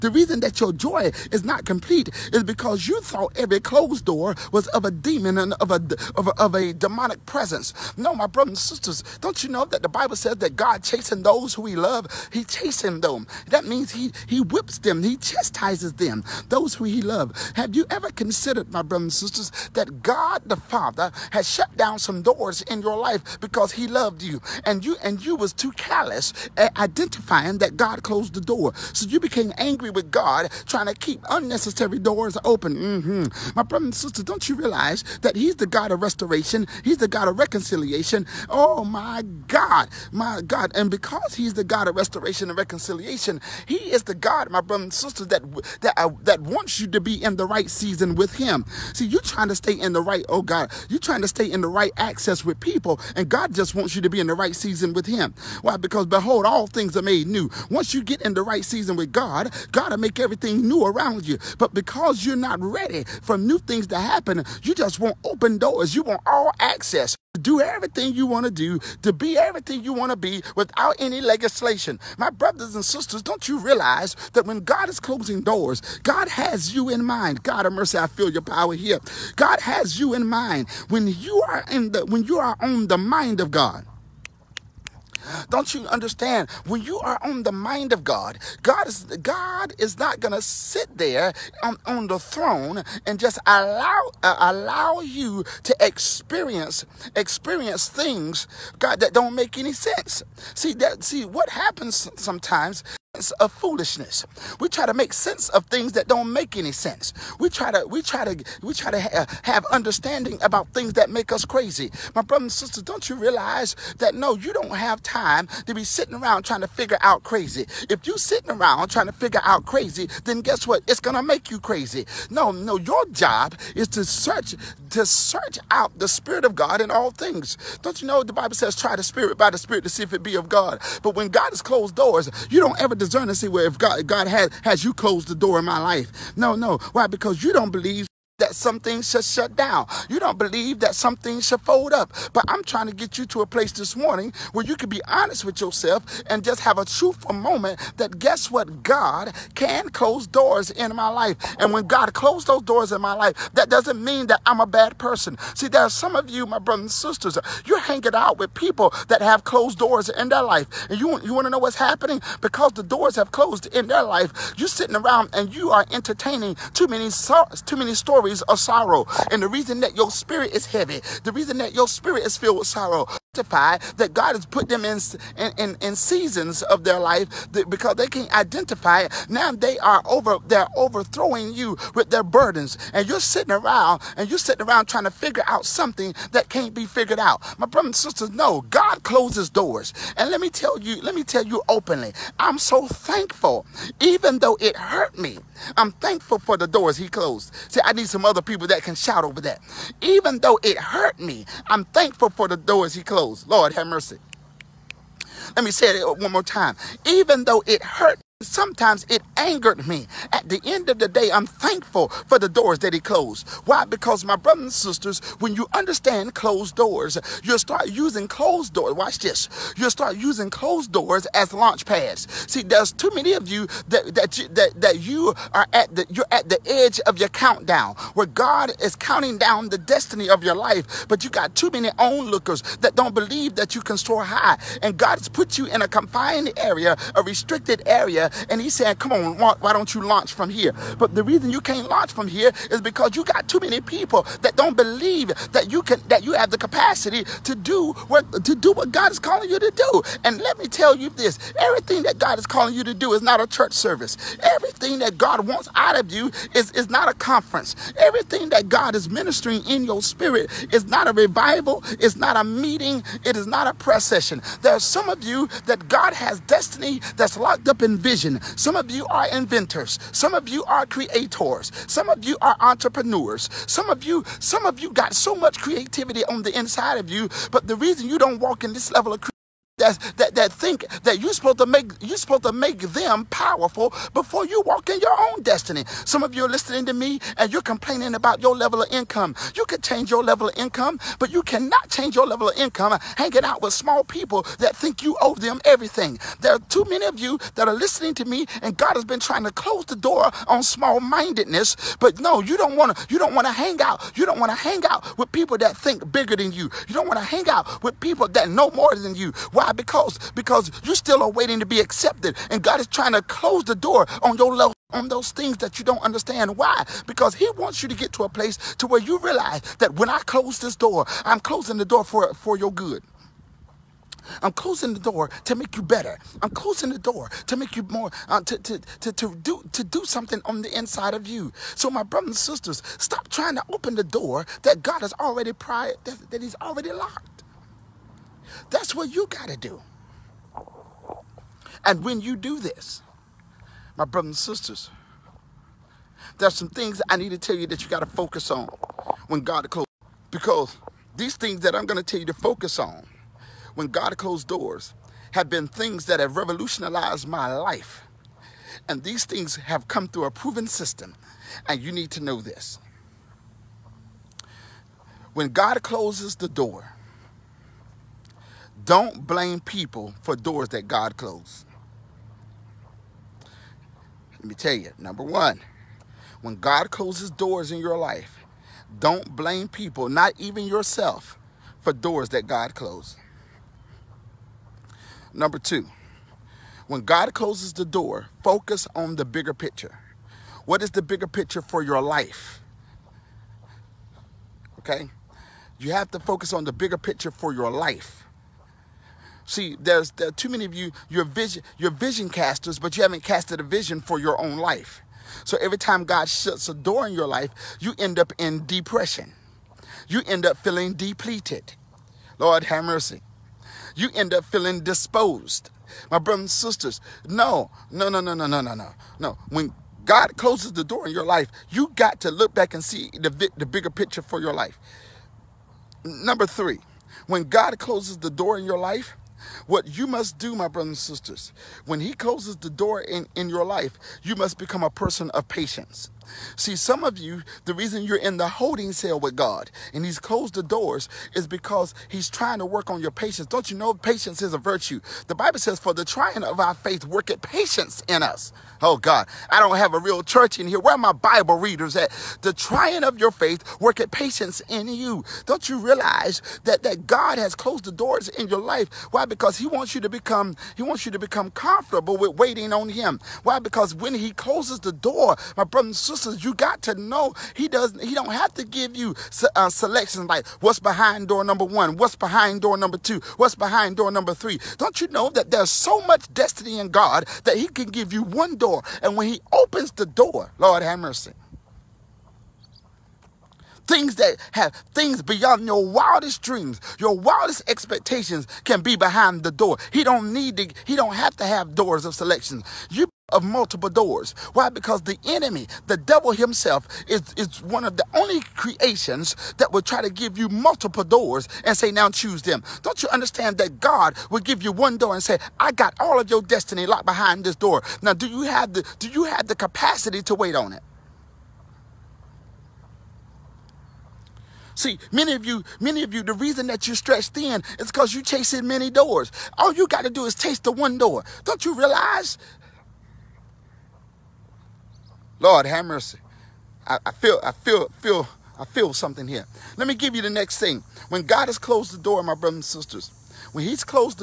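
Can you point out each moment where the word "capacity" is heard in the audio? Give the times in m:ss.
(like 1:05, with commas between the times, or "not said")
4:06, 8:29.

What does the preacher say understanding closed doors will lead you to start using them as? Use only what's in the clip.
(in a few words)
Launch pads.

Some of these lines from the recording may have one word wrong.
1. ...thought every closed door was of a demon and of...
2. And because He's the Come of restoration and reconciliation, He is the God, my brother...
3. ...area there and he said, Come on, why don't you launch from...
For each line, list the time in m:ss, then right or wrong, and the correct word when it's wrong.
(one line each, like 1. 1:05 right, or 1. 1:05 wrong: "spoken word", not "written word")
1. 0:03 right
2. 0:40 wrong: "God", not "Come"
3. 3:57 right.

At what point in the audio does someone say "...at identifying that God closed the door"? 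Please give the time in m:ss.
0:26.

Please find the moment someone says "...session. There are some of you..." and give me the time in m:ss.
4:24.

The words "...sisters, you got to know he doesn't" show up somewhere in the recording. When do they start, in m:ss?
7:46.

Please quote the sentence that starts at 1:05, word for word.
You want all access do everything you want to do, to be everything you want to be without any legislation.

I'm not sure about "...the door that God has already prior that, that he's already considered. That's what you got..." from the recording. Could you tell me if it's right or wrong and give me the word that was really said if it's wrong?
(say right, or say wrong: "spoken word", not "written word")
wrong: "locked", not "considered".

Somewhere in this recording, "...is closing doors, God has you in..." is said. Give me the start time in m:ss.
1:14.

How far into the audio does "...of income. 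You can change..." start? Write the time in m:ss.
4:48.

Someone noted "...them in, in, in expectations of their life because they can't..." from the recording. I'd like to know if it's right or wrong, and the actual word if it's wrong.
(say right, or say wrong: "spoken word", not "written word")
wrong: "seasons", not "expectations".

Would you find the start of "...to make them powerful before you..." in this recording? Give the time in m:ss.
4:42.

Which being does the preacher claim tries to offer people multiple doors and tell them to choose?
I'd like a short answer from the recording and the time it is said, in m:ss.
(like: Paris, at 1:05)
The devil, at 8:15.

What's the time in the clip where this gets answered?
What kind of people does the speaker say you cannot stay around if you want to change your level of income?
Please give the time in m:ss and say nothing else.
4:53.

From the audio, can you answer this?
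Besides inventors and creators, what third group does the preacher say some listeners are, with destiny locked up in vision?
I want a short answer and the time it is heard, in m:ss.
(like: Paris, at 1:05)
Entrepreneurs, at 4:32.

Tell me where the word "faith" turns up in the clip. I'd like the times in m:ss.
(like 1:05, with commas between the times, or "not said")
7:26, 7:33.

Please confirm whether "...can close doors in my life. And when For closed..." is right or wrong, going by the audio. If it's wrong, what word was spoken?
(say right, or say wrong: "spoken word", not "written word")
wrong: "God", not "For".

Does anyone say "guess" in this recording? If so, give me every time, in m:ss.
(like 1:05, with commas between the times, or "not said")
2:00, 2:28.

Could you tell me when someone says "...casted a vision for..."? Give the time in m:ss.
6:43.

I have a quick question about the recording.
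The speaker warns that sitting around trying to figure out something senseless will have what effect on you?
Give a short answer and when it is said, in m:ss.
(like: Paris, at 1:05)
Make you crazy, at 2:01.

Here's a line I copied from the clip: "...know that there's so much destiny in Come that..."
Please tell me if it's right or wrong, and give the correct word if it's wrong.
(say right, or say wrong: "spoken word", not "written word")
wrong: "God", not "Come".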